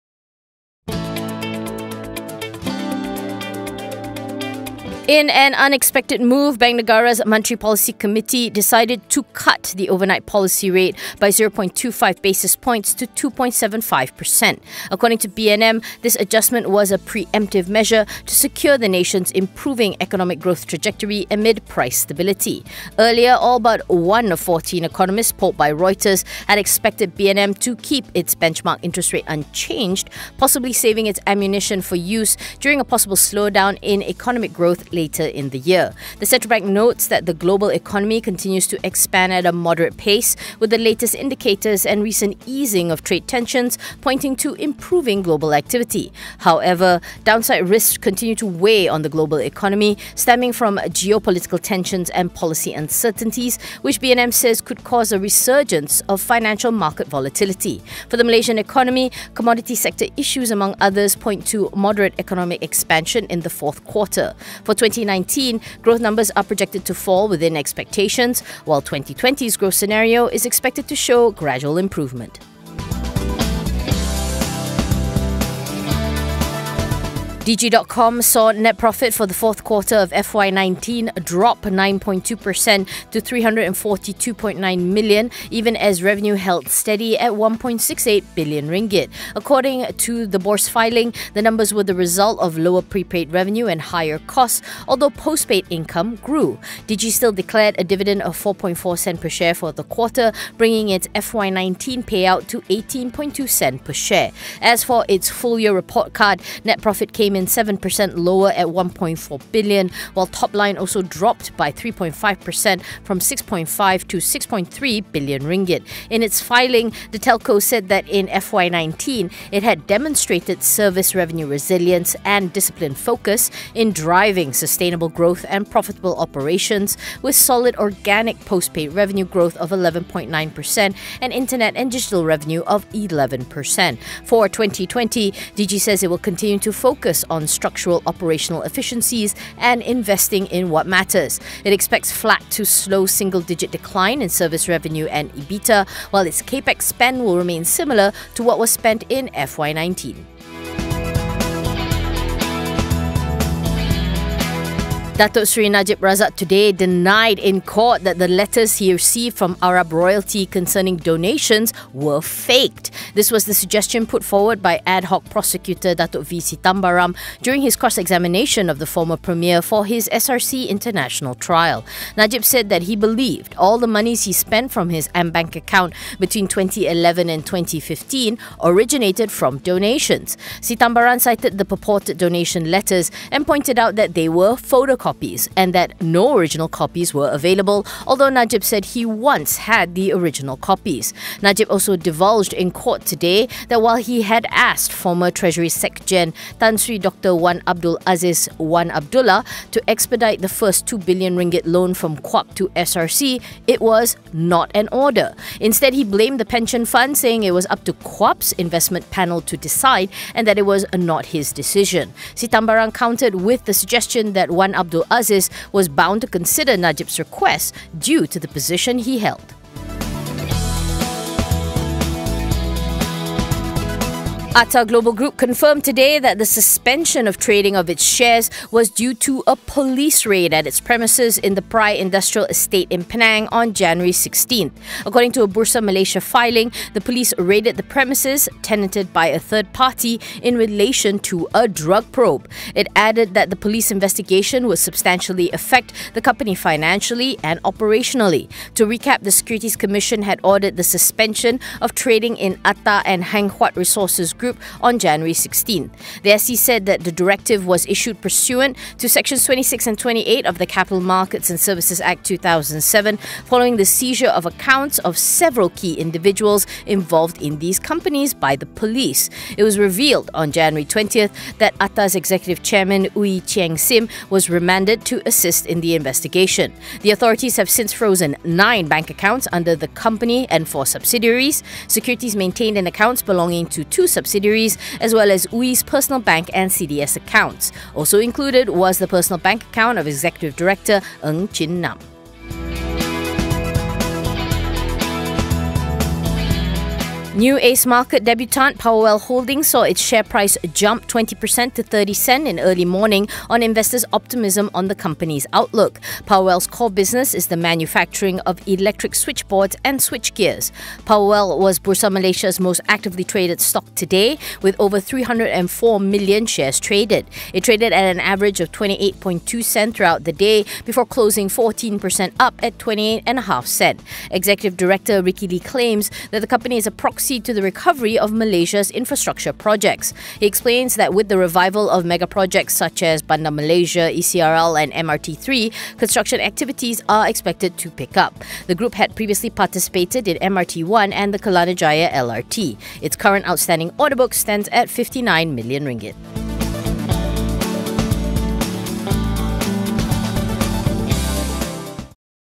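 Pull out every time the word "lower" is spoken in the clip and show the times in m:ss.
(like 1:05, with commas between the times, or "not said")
1:32, 1:48.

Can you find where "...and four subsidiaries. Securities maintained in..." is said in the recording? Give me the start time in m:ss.
4:40.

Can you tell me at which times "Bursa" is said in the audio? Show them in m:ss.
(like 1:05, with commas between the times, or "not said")
3:55, 5:11.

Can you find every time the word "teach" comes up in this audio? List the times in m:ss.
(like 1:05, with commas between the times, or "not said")
not said.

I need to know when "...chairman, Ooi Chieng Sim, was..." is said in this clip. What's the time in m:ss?
4:32.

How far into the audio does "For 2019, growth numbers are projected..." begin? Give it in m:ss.
1:04.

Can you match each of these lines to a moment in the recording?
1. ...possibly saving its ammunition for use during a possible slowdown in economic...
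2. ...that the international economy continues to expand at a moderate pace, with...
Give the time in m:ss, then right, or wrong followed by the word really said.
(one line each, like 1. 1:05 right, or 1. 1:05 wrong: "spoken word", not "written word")
1. 0:30 right
2. 0:37 wrong: "global", not "international".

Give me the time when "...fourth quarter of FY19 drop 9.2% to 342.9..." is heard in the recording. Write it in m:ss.
1:19.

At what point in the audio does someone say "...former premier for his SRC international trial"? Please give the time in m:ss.
2:48.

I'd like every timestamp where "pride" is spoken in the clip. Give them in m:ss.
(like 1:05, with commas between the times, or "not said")
not said.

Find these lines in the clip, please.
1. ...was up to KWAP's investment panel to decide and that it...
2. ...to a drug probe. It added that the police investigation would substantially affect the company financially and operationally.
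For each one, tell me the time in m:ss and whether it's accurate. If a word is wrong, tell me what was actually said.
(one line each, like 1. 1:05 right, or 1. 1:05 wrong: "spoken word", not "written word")
1. 3:27 right
2. 4:01 right.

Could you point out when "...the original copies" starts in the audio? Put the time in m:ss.
3:09.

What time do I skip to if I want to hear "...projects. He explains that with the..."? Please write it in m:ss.
5:29.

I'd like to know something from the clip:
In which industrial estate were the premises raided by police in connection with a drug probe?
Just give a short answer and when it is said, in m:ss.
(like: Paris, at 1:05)
Prai Industrial Estate, at 3:51.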